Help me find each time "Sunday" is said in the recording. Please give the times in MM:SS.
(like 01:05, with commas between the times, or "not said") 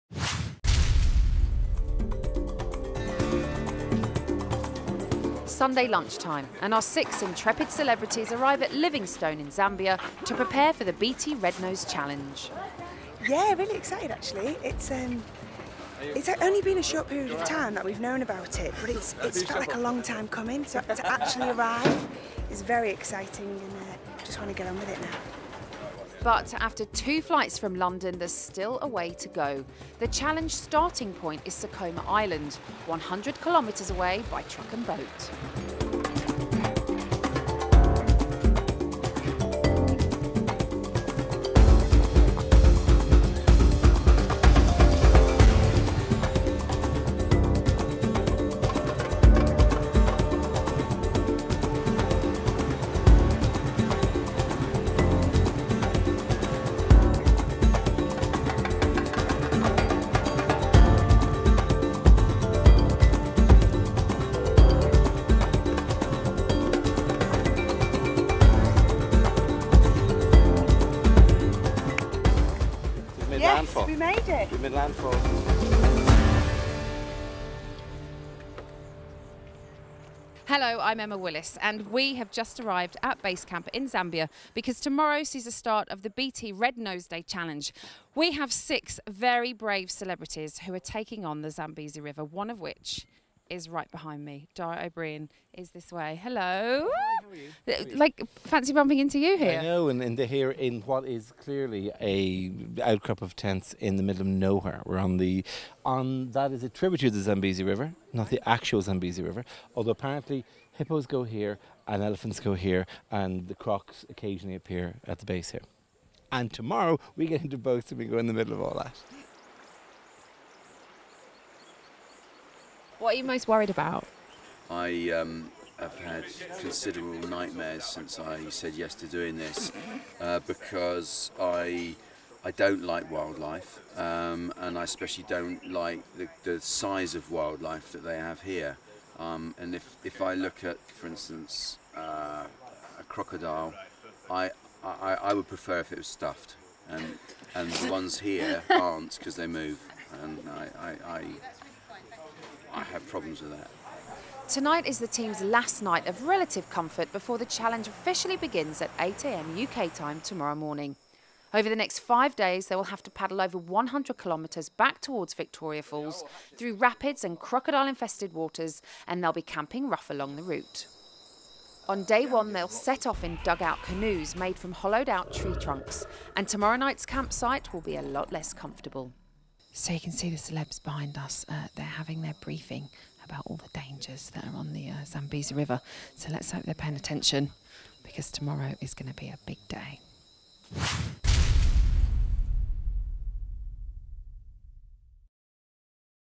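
00:05.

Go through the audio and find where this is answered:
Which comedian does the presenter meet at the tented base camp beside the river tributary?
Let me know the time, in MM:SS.
01:34.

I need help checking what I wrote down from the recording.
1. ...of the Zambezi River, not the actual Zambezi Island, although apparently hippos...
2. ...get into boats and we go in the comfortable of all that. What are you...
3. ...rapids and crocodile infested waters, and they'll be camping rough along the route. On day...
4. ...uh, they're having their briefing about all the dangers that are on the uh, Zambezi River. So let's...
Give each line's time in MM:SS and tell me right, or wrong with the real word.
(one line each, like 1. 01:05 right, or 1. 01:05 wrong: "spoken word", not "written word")
1. 01:47 wrong: "River", not "Island"
2. 01:57 wrong: "middle", not "comfortable"
3. 02:46 right
4. 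03:01 right.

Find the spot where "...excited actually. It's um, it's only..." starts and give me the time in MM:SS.
00:13.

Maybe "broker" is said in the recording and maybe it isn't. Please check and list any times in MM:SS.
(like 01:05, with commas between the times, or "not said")
not said.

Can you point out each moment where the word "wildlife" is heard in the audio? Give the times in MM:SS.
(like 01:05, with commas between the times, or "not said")
02:13, 02:17.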